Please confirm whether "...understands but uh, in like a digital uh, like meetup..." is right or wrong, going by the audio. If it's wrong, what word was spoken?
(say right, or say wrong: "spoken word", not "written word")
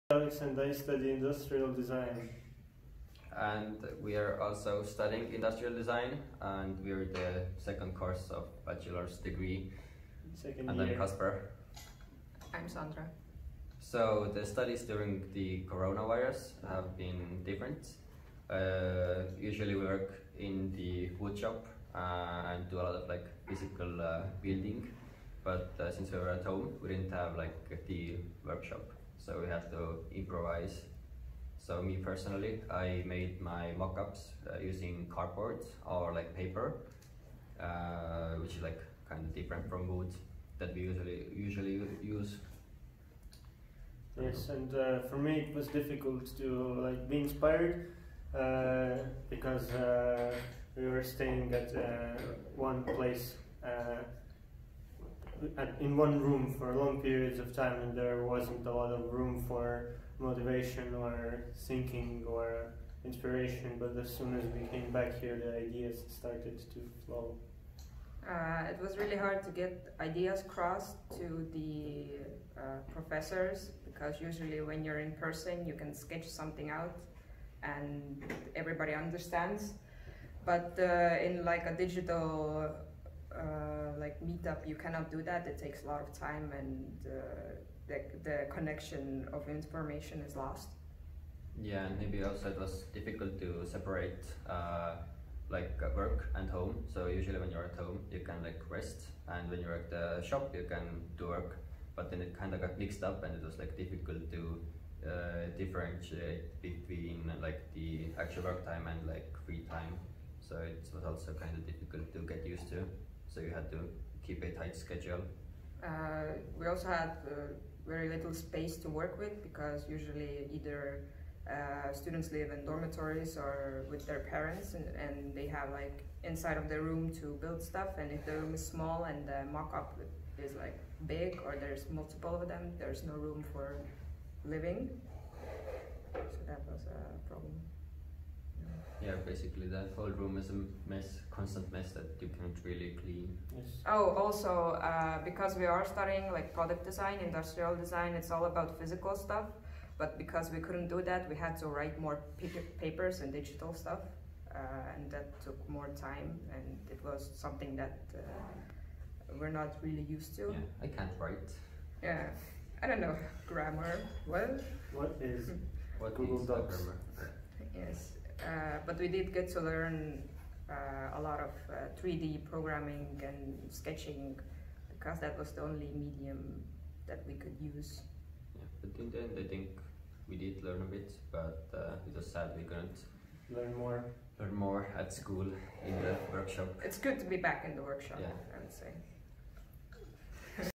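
right.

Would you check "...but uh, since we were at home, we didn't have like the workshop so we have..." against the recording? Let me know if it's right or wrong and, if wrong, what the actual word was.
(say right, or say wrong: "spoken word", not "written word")
right.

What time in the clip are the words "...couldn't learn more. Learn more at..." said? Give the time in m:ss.
3:02.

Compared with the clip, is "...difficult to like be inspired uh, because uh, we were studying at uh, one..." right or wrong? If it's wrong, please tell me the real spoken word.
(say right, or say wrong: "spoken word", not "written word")
wrong: "staying", not "studying".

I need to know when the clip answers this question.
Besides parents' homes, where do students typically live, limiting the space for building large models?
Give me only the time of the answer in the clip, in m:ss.
2:02.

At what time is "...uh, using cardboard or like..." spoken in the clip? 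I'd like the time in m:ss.
0:34.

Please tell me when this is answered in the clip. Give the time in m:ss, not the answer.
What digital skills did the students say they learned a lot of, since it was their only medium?
2:52.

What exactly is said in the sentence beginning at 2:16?
So that was a problem basically that whole room is a mess, constant mess that you can't really clean.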